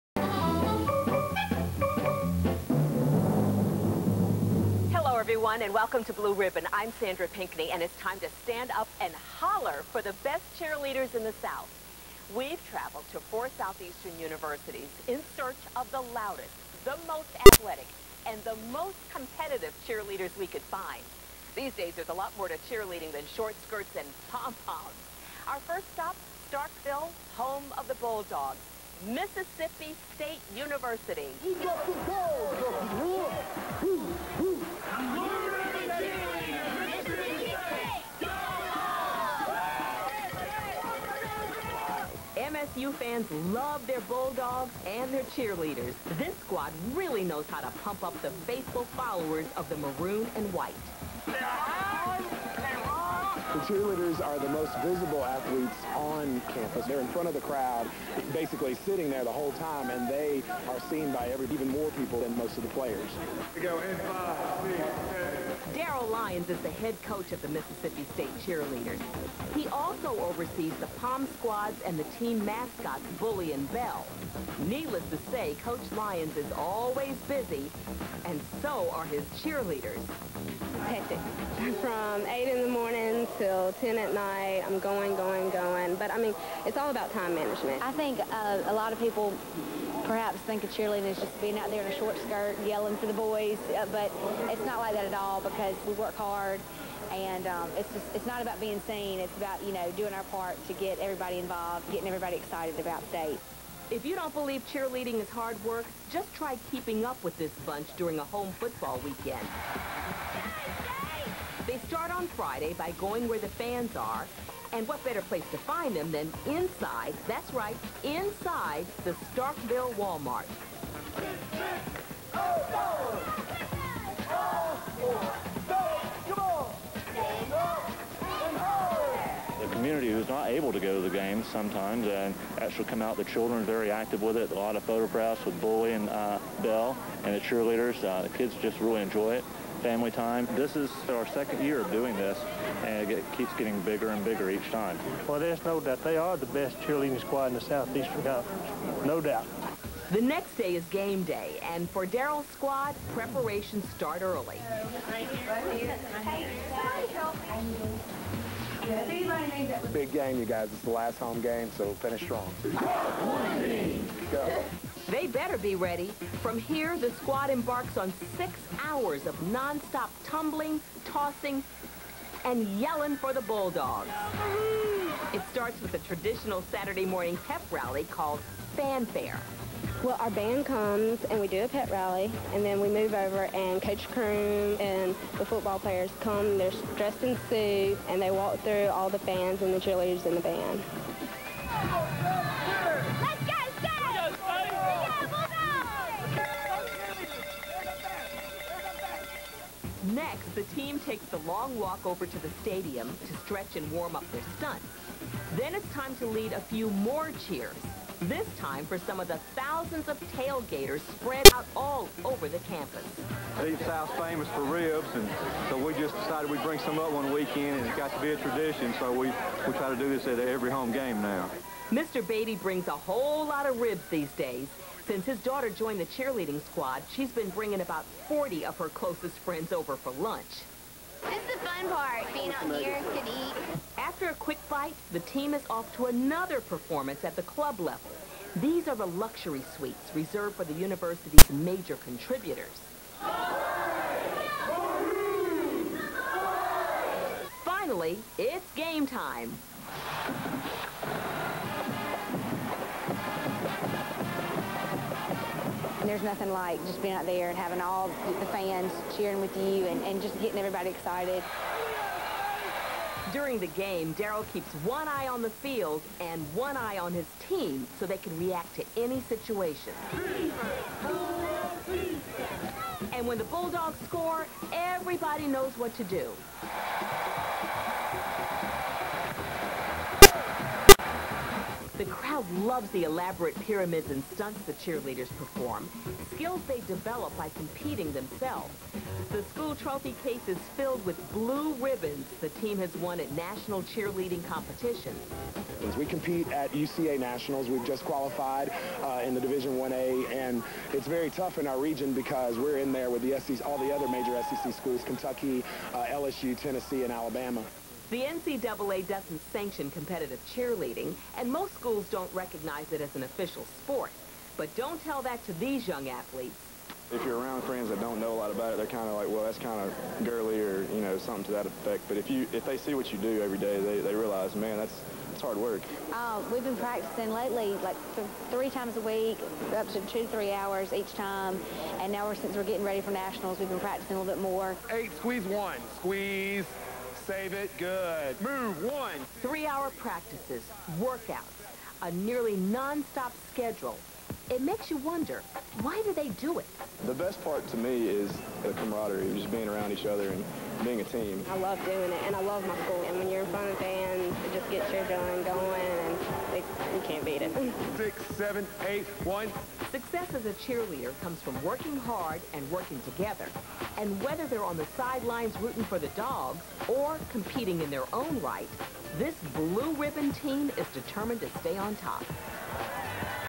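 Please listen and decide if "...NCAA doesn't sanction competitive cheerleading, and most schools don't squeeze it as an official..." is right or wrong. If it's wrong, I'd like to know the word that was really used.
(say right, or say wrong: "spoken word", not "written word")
wrong: "recognize", not "squeeze".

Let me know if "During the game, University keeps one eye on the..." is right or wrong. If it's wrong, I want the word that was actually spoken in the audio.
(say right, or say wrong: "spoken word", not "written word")
wrong: "Daryl", not "University".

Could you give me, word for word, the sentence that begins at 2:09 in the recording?
The community who's not able to go to the games sometimes and actually come out.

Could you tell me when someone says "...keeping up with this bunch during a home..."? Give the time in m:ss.
1:46.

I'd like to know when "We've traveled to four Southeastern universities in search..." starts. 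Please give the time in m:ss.
0:12.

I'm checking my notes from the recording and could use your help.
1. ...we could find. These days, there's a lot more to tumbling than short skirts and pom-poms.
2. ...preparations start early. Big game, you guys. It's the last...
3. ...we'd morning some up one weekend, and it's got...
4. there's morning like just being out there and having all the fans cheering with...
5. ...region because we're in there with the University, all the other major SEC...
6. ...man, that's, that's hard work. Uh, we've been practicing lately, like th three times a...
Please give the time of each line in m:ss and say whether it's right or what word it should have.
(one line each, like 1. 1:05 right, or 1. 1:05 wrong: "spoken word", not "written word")
1. 0:20 wrong: "cheerleading", not "tumbling"
2. 2:33 right
3. 3:36 wrong: "bring", not "morning"
4. 4:16 wrong: "nothing", not "morning"
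5. 5:01 wrong: "SEC", not "University"
6. 5:24 right.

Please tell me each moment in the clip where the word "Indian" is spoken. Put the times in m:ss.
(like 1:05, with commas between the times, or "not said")
not said.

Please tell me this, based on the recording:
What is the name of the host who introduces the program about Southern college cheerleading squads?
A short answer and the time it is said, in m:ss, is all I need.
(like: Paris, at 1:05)
Sandra Pinkney, at 0:06.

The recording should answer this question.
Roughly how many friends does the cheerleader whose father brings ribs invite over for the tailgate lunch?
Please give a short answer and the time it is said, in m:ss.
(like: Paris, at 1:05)
40, at 3:48.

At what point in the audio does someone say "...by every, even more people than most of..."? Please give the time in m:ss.
1:01.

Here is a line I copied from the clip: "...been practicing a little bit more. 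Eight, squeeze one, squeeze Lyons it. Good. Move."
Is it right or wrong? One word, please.
wrong.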